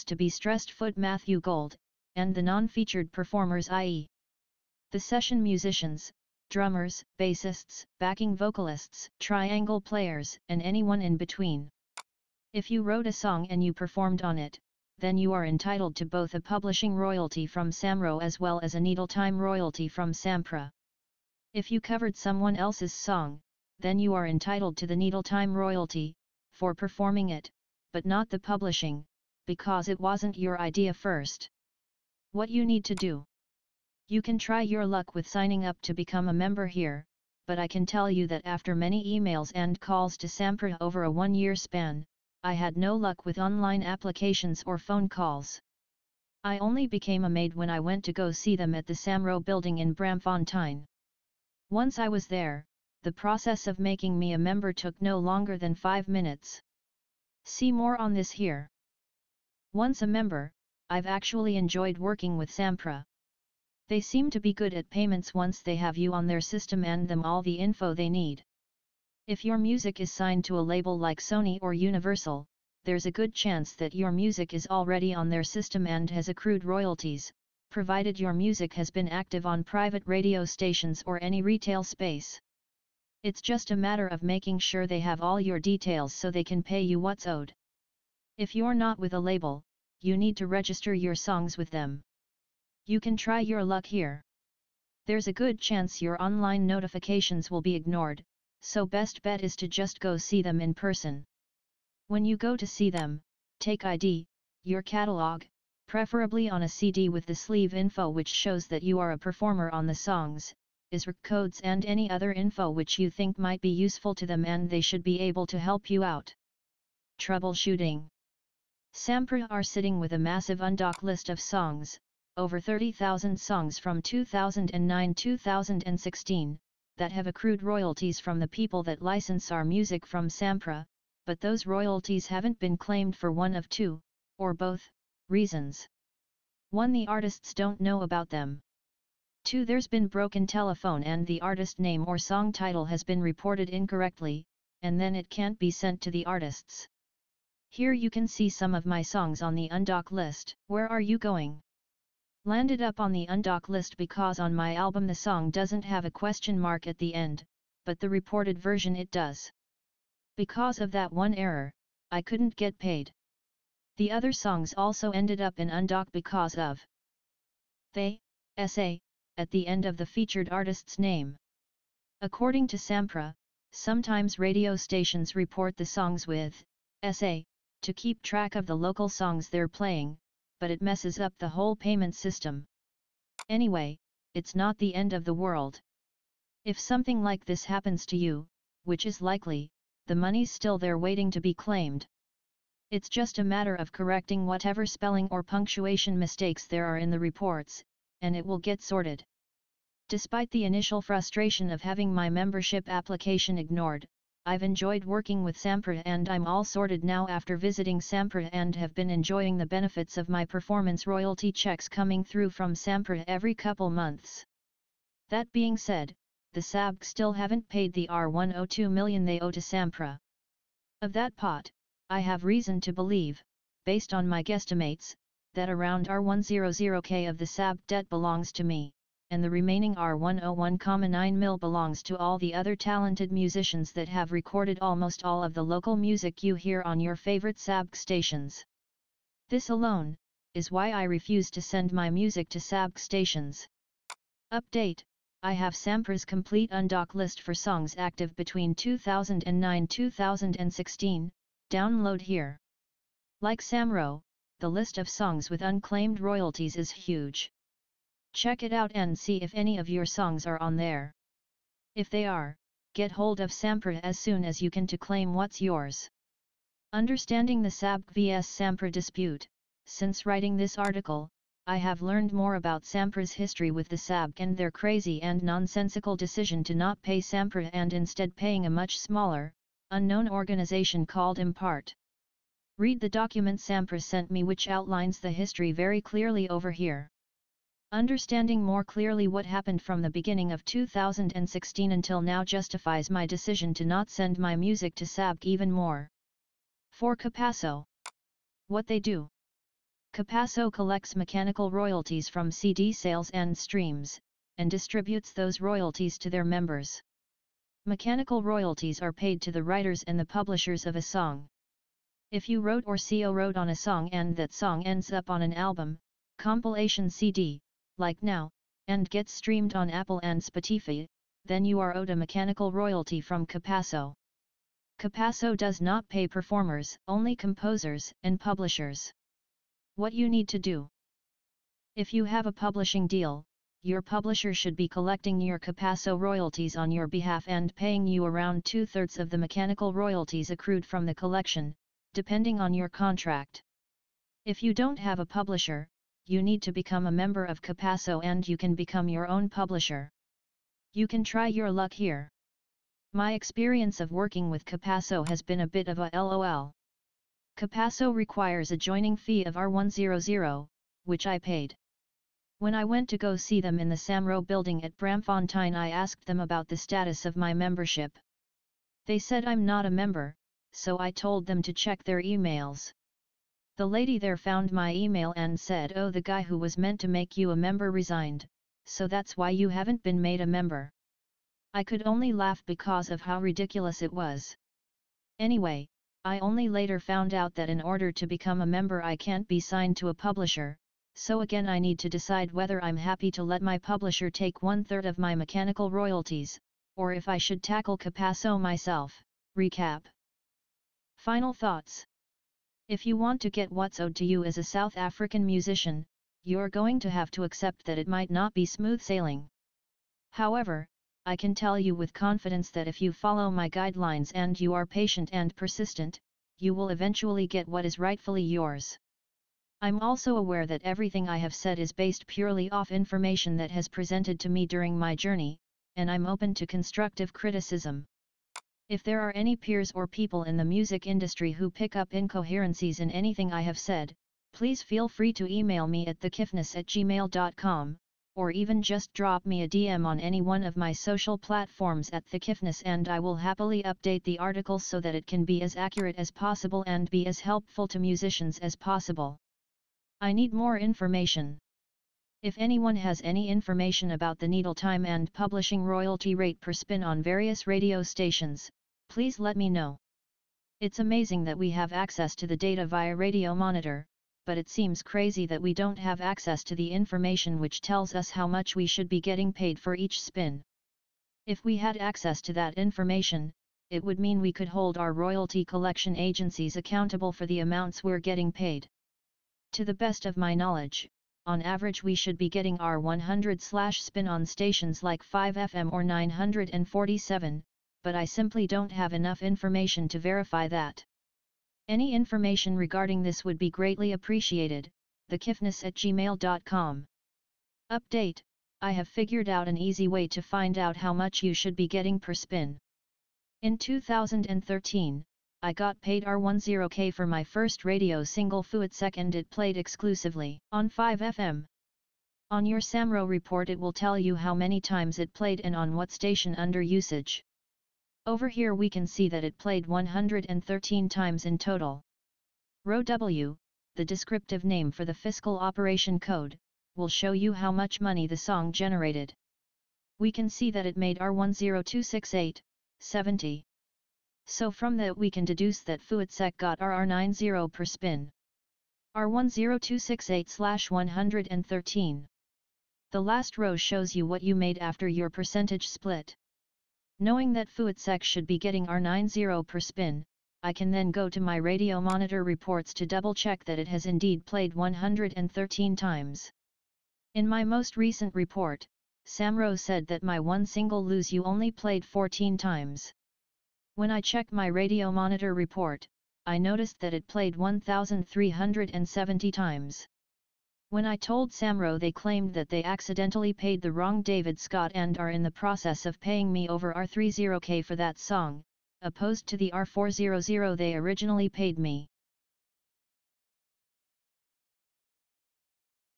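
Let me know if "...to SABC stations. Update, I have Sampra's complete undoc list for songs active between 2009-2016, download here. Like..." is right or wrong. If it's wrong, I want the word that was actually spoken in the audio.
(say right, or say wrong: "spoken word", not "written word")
right.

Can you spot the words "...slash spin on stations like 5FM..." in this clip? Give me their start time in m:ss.
8:03.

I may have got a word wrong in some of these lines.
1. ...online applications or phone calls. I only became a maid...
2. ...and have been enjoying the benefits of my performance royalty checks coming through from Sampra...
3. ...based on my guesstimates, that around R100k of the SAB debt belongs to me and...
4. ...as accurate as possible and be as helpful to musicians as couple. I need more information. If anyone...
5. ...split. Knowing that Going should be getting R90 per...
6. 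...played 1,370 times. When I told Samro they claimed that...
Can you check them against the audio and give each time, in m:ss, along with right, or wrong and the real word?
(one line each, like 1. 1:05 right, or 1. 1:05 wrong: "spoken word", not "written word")
1. 0:43 right
2. 3:28 right
3. 3:43 right
4. 7:25 wrong: "possible", not "couple"
5. 9:05 wrong: "Fuitsek", not "Going"
6. 9:27 right.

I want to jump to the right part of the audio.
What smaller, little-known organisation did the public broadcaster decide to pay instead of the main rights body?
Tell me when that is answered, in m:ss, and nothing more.
4:41.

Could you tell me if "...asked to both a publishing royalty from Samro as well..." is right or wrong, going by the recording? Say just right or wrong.
wrong.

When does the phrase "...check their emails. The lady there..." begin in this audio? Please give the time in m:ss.
6:11.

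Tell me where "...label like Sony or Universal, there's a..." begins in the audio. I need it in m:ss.
1:10.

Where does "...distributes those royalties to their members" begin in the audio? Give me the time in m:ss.
5:04.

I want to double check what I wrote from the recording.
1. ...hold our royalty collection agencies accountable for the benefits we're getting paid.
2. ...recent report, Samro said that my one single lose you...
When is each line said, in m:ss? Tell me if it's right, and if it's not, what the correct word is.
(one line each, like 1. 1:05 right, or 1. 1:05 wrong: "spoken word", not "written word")
1. 7:54 wrong: "amounts", not "benefits"
2. 9:17 right.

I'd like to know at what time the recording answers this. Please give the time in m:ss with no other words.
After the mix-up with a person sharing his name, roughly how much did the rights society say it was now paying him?
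9:36.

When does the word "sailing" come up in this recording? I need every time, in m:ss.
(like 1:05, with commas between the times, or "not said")
6:49.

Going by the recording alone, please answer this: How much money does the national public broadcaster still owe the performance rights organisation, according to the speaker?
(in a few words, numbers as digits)
R102 million.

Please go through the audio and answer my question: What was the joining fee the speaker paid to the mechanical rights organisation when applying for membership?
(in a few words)
R100.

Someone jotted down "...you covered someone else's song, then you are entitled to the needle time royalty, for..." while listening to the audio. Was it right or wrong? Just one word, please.
right.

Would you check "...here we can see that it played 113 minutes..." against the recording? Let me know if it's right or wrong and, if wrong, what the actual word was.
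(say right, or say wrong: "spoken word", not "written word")
wrong: "times", not "minutes".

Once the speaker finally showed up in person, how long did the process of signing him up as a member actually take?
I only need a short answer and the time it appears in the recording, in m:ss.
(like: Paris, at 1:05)
5 minutes, at 0:55.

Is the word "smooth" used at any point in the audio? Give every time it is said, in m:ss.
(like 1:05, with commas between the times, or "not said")
6:48.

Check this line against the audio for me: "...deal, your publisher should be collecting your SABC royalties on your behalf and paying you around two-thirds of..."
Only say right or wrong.
wrong.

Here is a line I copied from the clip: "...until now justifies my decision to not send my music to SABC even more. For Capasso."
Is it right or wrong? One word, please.
right.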